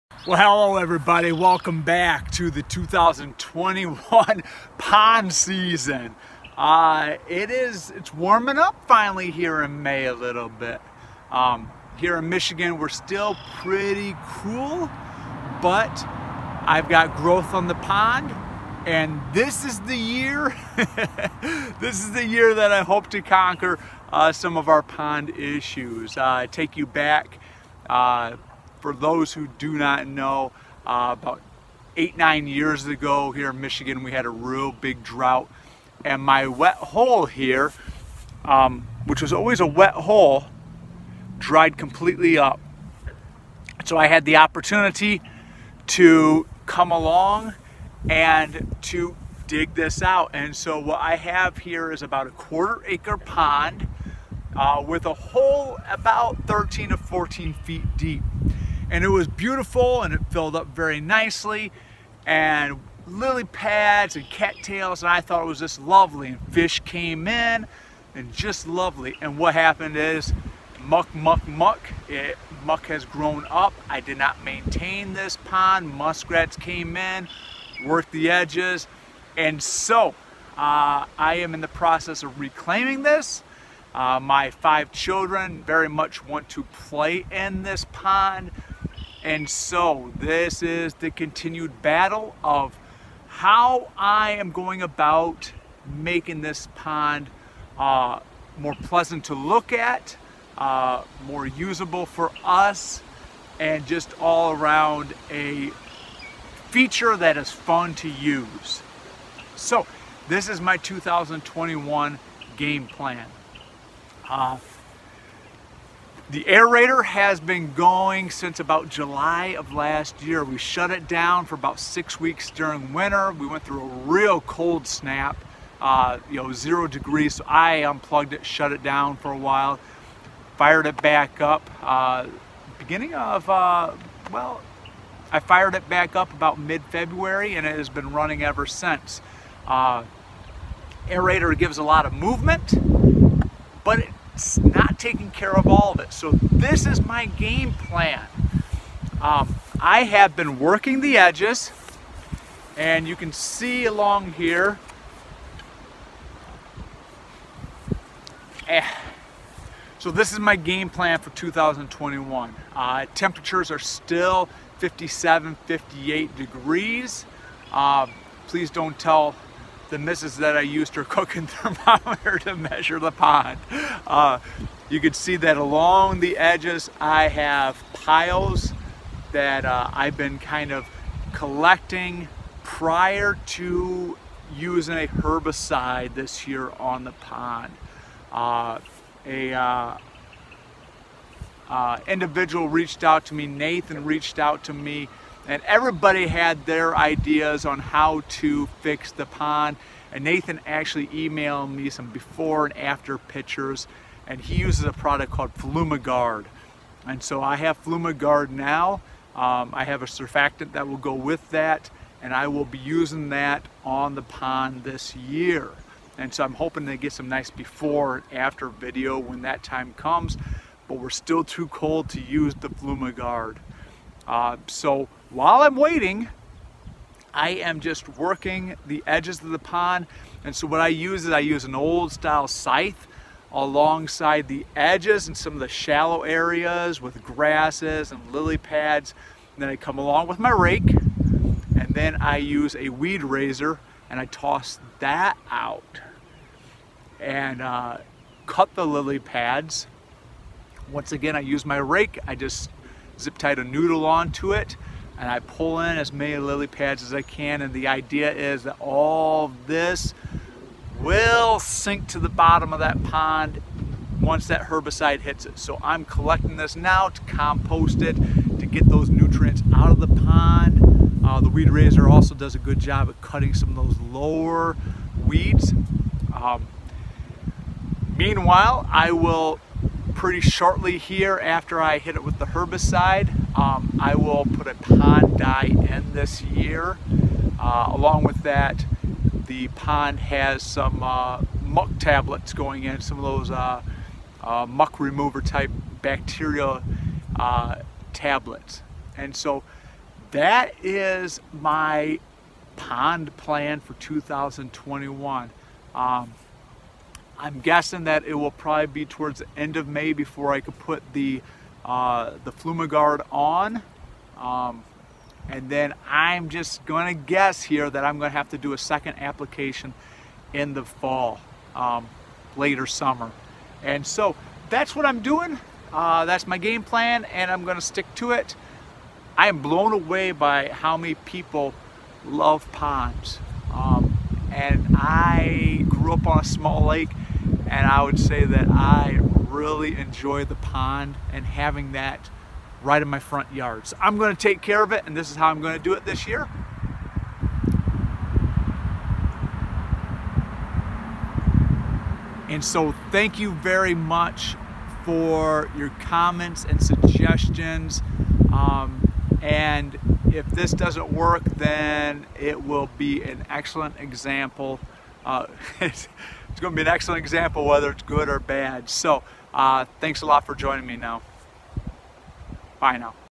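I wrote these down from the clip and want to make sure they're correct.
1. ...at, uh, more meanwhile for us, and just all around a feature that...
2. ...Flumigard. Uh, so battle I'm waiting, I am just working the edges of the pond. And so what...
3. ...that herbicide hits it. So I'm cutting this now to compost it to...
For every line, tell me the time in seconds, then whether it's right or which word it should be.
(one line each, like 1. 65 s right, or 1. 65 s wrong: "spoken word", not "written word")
1. 99 s wrong: "usable", not "meanwhile"
2. 222 s wrong: "while", not "battle"
3. 264 s wrong: "collecting", not "cutting".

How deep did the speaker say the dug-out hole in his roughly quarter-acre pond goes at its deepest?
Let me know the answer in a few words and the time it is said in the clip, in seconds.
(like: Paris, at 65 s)
13 to 14 feet, at 56 s.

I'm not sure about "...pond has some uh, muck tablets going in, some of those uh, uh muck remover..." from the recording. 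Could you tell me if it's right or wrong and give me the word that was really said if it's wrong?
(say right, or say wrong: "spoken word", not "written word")
right.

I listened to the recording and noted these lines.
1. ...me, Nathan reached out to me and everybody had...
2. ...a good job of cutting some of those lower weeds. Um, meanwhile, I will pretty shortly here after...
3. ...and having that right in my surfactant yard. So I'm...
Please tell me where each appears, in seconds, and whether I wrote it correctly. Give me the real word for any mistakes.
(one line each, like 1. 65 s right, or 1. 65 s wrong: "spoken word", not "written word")
1. 193 s right
2. 272 s right
3. 341 s wrong: "front", not "surfactant".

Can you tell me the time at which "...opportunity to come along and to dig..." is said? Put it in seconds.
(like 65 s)
44 s.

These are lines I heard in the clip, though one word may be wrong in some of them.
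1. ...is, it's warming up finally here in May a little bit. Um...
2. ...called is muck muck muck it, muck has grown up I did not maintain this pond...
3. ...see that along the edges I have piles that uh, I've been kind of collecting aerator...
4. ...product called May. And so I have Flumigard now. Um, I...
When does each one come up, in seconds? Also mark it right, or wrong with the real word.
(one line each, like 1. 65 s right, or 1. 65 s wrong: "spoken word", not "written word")
1. 7 s right
2. 69 s wrong: "happened", not "called"
3. 175 s wrong: "prior", not "aerator"
4. 204 s wrong: "Flumigard", not "May".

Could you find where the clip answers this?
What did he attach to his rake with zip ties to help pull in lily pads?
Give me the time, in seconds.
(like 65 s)
253 s.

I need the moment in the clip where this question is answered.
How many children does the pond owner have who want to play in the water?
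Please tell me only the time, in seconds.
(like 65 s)
84 s.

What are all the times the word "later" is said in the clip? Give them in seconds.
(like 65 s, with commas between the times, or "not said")
322 s.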